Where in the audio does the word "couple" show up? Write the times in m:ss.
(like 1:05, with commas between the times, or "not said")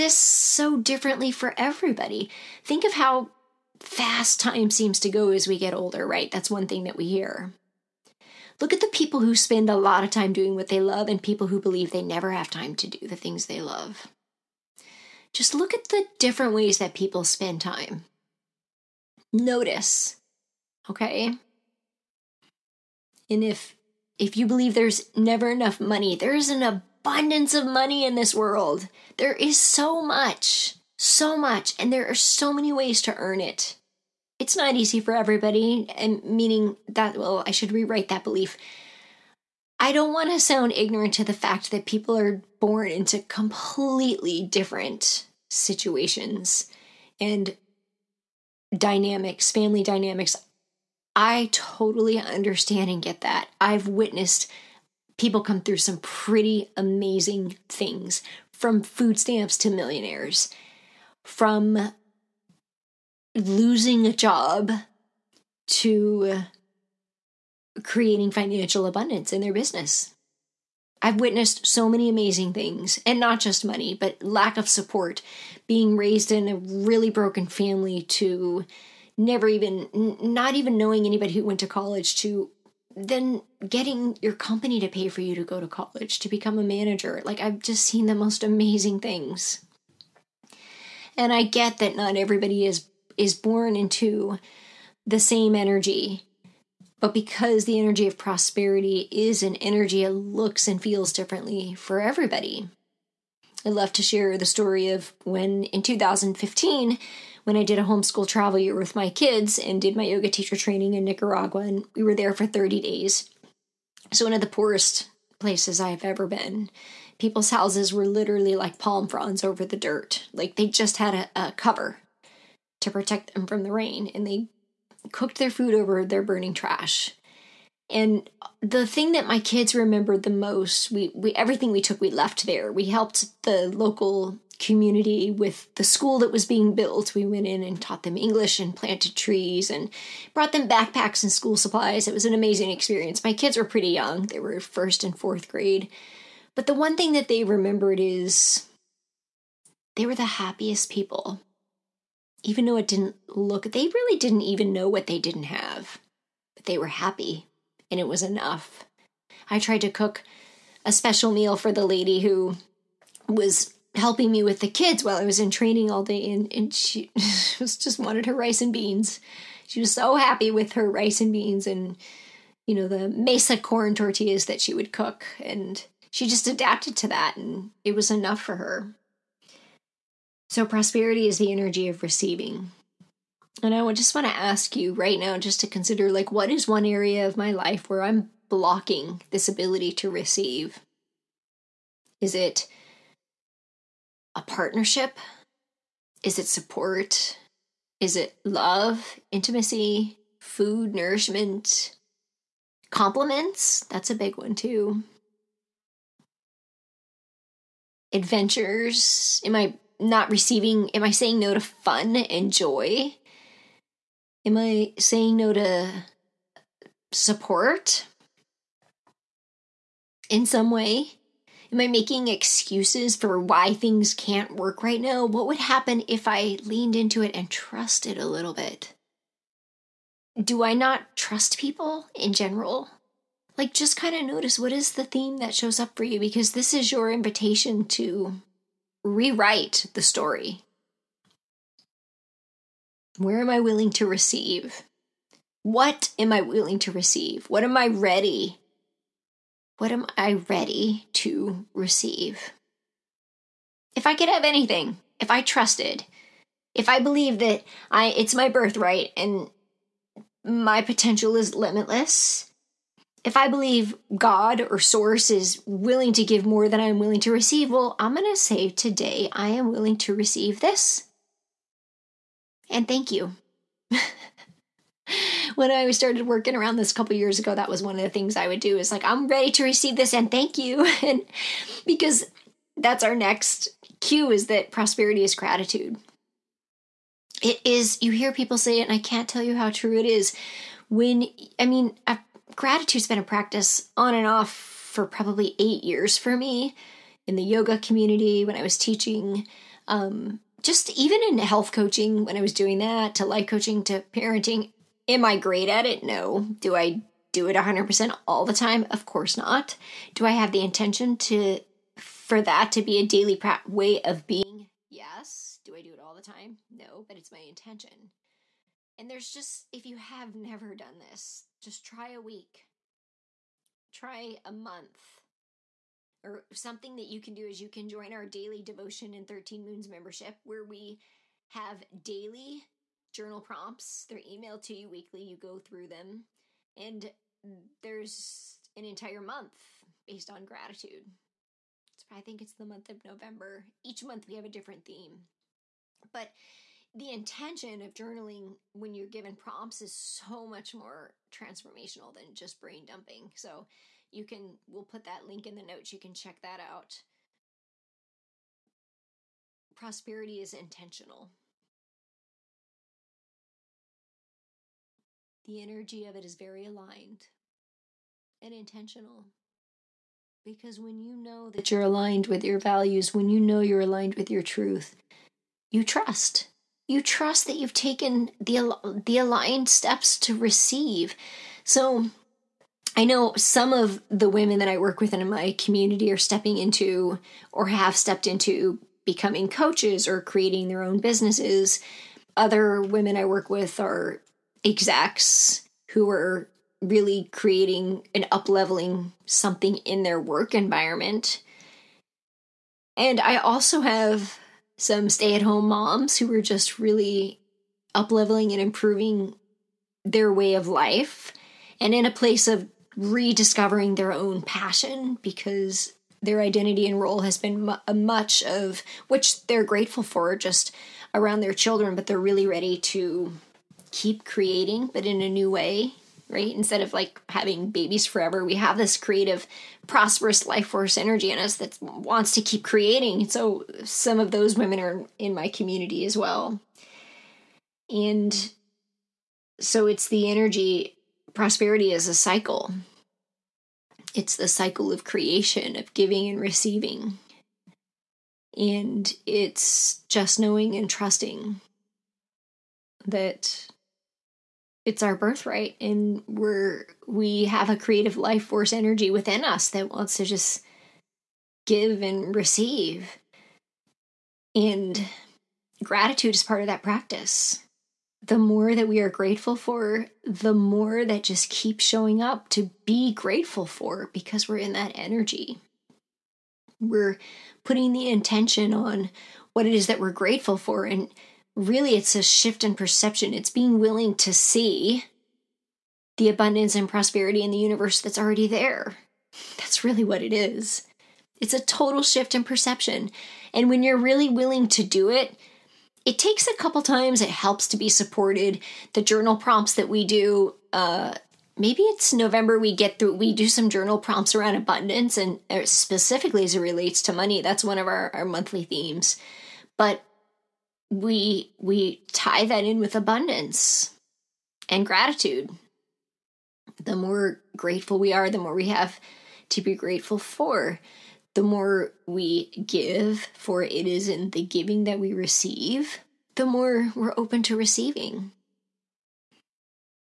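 4:36, 8:16.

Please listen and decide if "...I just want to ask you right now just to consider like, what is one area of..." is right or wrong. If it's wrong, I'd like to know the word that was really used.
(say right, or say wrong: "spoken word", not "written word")
right.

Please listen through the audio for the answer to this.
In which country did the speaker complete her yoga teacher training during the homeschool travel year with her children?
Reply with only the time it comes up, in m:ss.
1:51.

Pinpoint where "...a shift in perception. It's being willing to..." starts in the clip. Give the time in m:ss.
8:02.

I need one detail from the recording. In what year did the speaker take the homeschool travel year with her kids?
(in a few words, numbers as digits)
2015.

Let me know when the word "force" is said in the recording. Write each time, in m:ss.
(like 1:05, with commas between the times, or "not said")
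7:10, 7:38.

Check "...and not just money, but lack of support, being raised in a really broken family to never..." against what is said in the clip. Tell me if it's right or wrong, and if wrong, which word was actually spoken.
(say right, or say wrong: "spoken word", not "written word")
right.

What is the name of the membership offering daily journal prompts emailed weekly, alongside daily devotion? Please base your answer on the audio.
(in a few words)
13 moons.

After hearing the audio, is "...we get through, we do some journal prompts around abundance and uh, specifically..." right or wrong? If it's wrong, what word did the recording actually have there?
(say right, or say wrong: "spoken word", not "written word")
right.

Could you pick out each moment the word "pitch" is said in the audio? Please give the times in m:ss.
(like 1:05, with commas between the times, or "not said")
not said.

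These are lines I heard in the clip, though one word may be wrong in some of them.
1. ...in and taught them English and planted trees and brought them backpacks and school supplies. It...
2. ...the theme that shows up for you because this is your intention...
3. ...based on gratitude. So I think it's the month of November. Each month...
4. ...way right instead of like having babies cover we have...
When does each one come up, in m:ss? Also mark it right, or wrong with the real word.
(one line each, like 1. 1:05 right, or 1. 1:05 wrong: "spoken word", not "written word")
1. 2:17 right
2. 3:54 wrong: "invitation", not "intention"
3. 5:40 right
4. 7:05 wrong: "forever", not "cover".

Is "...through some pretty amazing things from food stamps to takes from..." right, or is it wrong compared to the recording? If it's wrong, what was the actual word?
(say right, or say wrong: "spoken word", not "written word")
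wrong: "millionaires", not "takes".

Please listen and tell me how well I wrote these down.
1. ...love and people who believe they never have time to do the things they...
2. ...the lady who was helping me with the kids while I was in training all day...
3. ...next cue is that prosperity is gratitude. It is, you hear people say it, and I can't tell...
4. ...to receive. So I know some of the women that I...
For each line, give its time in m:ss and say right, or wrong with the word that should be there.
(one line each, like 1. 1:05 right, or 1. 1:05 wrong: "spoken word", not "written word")
1. 0:10 right
2. 2:41 right
3. 4:43 right
4. 6:20 right.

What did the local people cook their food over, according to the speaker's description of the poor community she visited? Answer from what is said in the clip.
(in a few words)
burning trash.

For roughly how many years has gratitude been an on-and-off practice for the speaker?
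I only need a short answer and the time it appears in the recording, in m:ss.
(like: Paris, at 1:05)
8, at 4:55.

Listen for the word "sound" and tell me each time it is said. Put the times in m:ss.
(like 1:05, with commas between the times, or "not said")
0:40.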